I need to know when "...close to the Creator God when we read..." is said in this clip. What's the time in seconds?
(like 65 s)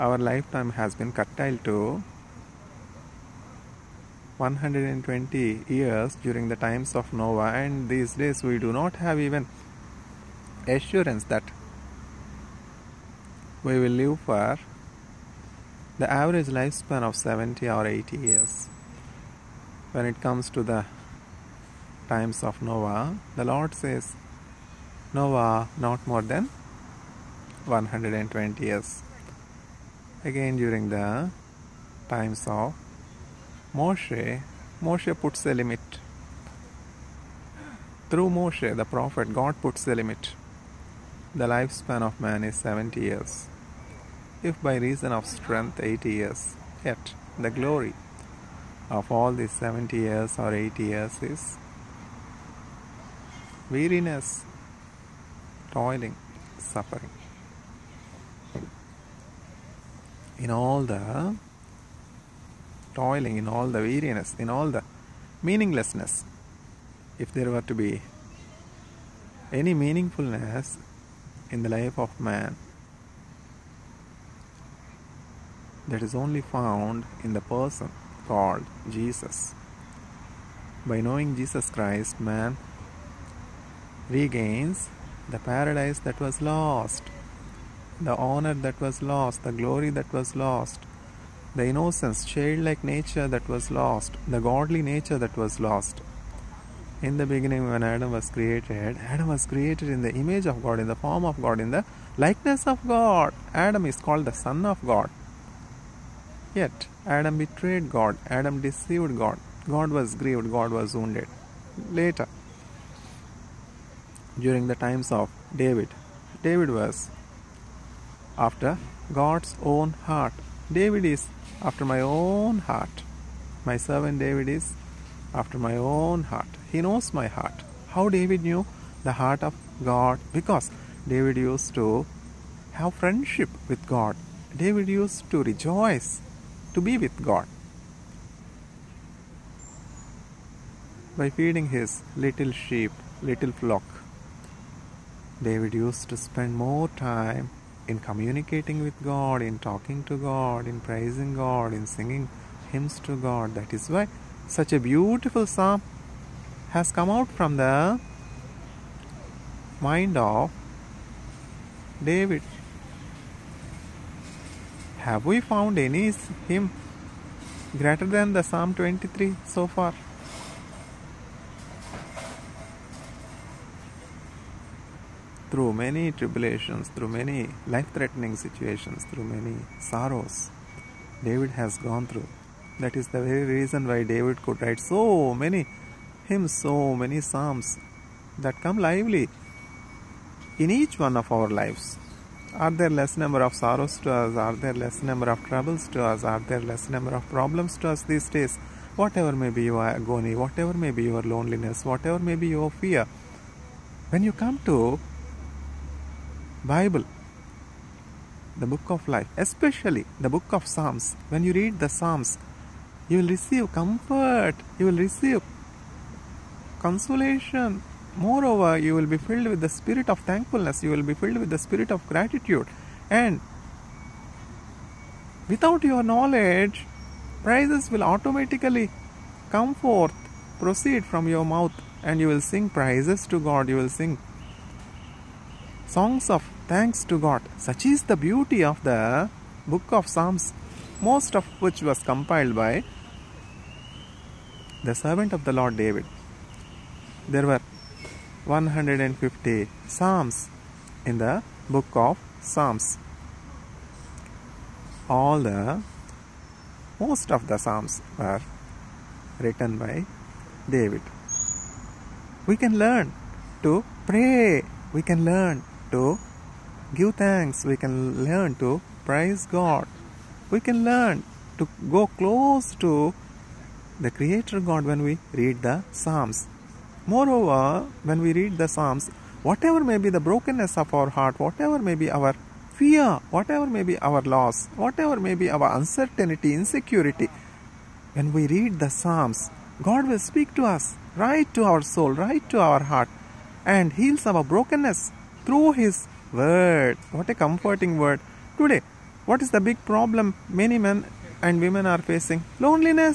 272 s.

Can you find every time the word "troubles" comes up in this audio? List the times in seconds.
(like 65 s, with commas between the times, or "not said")
195 s.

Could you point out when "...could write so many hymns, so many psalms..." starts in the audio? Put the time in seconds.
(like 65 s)
184 s.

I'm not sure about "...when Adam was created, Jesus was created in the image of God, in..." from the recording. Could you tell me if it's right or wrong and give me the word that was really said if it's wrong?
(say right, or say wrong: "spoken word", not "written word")
wrong: "Adam", not "Jesus".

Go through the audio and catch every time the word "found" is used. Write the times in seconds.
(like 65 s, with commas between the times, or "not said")
76 s, 165 s.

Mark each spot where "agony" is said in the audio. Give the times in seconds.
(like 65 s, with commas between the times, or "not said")
199 s.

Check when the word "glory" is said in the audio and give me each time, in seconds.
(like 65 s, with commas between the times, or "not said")
47 s, 89 s.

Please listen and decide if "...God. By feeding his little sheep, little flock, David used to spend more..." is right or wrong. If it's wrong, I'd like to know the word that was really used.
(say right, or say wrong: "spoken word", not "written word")
right.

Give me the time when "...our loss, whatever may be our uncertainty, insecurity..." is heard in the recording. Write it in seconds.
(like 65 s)
283 s.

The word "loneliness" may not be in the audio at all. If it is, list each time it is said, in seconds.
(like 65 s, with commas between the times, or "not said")
201 s, 302 s.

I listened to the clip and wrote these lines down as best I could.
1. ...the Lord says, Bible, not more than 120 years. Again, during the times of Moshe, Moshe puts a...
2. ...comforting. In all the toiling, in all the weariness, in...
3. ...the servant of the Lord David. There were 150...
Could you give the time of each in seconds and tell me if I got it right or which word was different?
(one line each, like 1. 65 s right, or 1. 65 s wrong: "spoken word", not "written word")
1. 23 s wrong: "Noah", not "Bible"
2. 56 s wrong: "suffering", not "comforting"
3. 244 s right.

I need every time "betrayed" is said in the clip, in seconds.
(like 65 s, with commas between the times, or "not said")
107 s.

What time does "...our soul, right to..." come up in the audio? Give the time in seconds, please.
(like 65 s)
291 s.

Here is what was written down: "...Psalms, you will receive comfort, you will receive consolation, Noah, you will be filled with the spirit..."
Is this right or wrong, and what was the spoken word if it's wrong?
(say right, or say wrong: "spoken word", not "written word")
wrong: "Moreover", not "Noah".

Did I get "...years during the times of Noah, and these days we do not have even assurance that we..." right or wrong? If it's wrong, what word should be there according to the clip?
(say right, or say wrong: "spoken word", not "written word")
right.